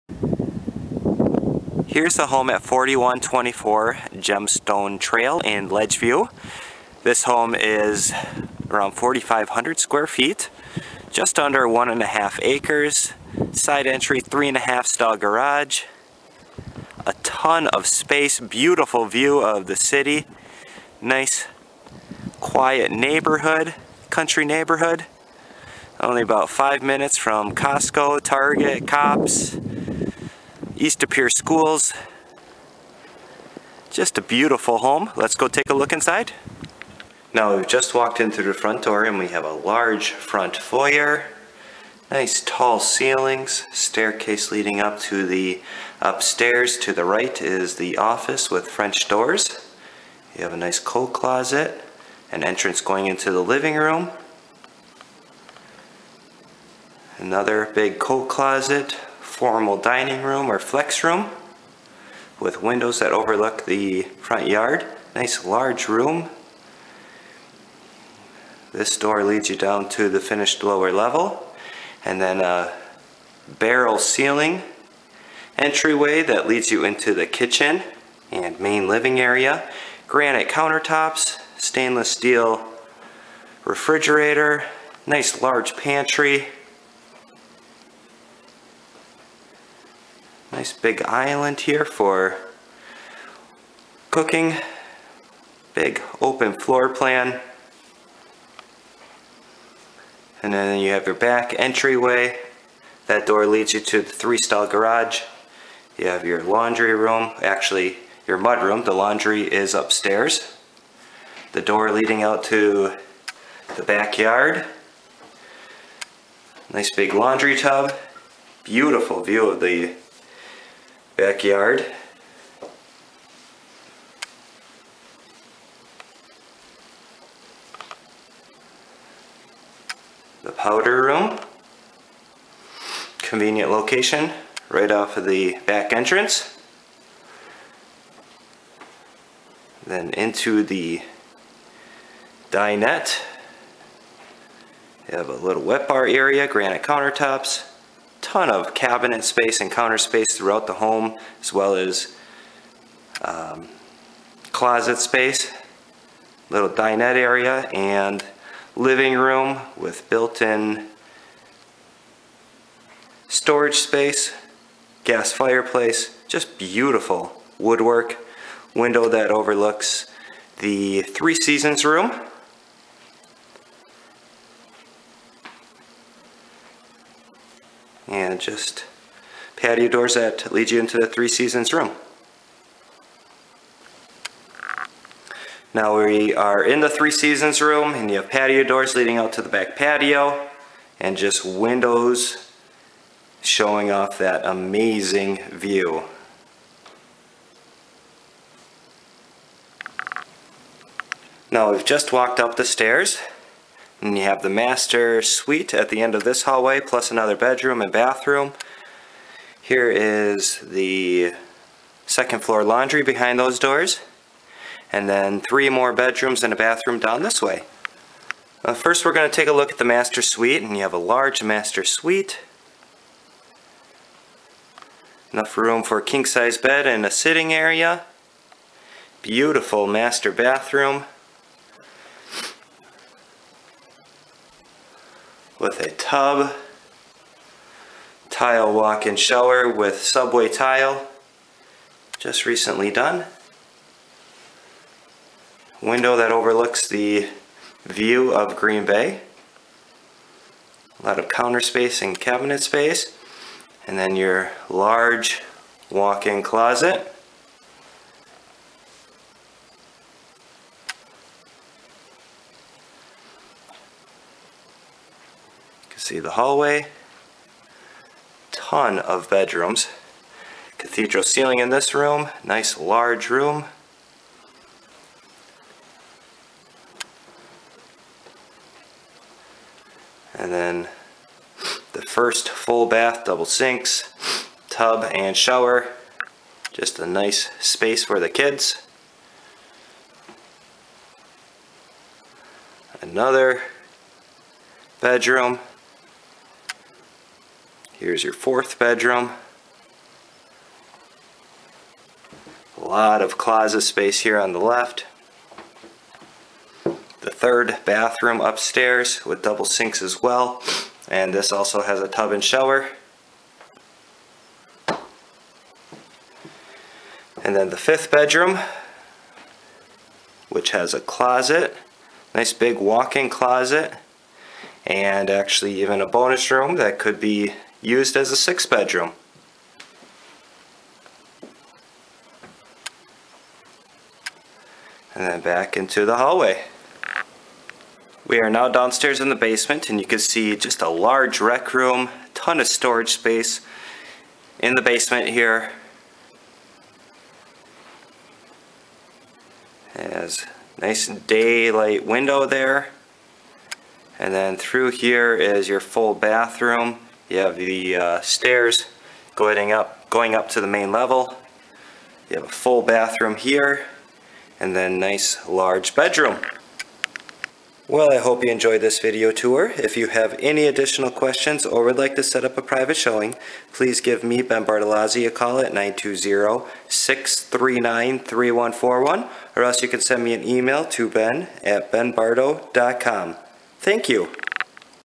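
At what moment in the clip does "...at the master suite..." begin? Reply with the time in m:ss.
3:39.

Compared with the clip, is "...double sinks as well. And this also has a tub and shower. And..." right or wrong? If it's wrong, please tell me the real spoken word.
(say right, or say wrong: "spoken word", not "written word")
right.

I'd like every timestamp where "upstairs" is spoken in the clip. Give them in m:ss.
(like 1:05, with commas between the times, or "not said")
0:46, 1:49, 5:08.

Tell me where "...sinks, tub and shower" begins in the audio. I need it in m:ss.
4:43.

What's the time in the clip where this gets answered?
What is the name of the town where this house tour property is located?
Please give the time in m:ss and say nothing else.
0:05.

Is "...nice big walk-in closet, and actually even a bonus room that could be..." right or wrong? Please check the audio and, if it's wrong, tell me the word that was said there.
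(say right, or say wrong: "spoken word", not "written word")
right.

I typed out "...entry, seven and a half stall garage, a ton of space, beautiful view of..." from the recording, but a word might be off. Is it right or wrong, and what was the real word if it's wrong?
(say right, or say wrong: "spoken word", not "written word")
wrong: "three", not "seven".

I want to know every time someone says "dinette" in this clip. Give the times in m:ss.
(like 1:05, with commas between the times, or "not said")
2:22, 2:36.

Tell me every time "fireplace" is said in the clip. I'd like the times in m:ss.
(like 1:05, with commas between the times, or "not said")
2:45.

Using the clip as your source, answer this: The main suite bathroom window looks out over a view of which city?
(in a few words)
Green Bay.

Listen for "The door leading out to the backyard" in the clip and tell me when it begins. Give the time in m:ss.
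1:51.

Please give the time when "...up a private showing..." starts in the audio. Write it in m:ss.
6:12.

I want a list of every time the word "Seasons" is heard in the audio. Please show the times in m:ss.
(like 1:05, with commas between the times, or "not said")
2:51, 3:01, 3:07.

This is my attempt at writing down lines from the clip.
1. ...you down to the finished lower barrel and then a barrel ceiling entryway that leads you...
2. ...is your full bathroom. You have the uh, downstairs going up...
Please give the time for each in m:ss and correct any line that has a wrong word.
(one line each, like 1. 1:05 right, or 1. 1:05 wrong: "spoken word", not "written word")
1. 1:09 wrong: "level", not "barrel"
2. 5:55 wrong: "stairs", not "downstairs".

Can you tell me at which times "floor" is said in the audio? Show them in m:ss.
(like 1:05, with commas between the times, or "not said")
1:36, 3:32.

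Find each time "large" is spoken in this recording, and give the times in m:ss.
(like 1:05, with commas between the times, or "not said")
0:39, 1:05, 1:25, 3:40, 4:14, 4:32, 5:40, 6:05.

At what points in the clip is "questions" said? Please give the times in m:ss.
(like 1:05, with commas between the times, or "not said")
6:11.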